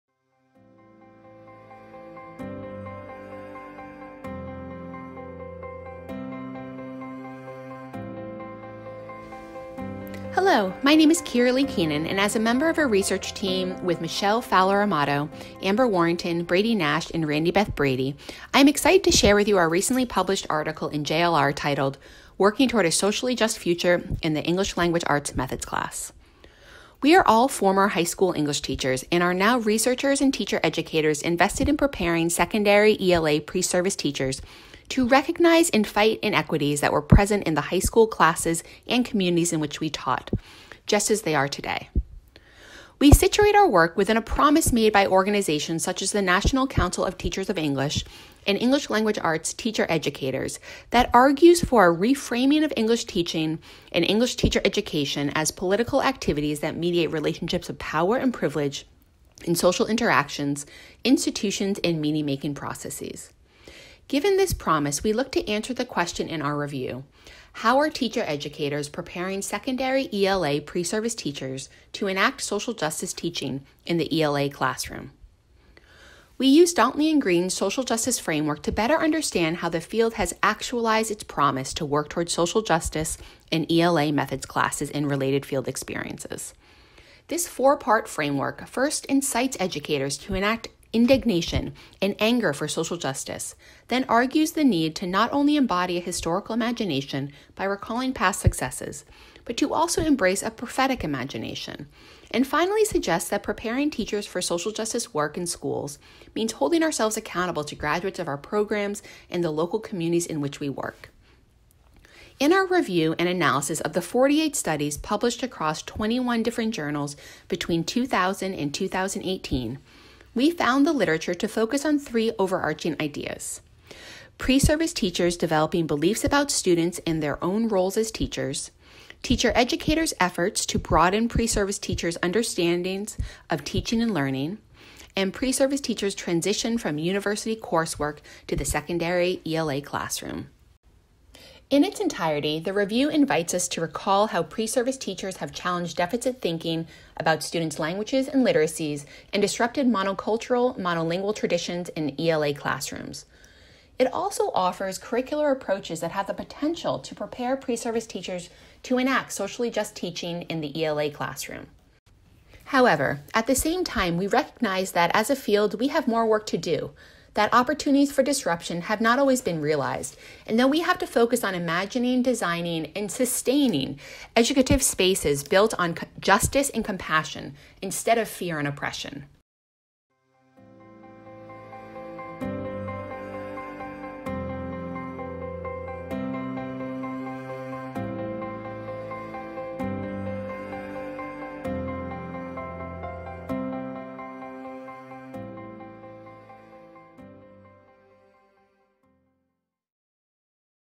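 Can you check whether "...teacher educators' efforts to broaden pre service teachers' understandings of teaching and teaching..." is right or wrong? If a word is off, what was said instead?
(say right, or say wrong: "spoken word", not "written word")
wrong: "learning", not "teaching".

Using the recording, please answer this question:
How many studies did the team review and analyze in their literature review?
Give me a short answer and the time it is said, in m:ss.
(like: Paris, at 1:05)
48, at 1:54.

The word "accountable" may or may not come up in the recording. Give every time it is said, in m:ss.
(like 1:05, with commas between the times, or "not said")
1:47.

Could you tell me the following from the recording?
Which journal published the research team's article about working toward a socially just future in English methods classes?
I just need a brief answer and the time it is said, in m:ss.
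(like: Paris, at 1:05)
JLR, at 0:21.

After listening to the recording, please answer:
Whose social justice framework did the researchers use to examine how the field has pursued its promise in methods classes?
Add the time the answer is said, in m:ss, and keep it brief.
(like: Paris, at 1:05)
Dantley and Green, at 1:16.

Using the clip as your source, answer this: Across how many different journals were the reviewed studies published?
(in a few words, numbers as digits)
21.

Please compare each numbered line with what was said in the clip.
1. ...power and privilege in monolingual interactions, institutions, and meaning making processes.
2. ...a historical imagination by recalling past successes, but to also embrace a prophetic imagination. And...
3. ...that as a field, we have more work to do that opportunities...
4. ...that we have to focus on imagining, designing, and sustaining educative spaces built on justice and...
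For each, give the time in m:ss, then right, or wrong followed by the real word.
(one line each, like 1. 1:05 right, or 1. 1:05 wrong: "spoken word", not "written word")
1. 0:57 wrong: "social", not "monolingual"
2. 1:35 right
3. 2:44 right
4. 2:50 right.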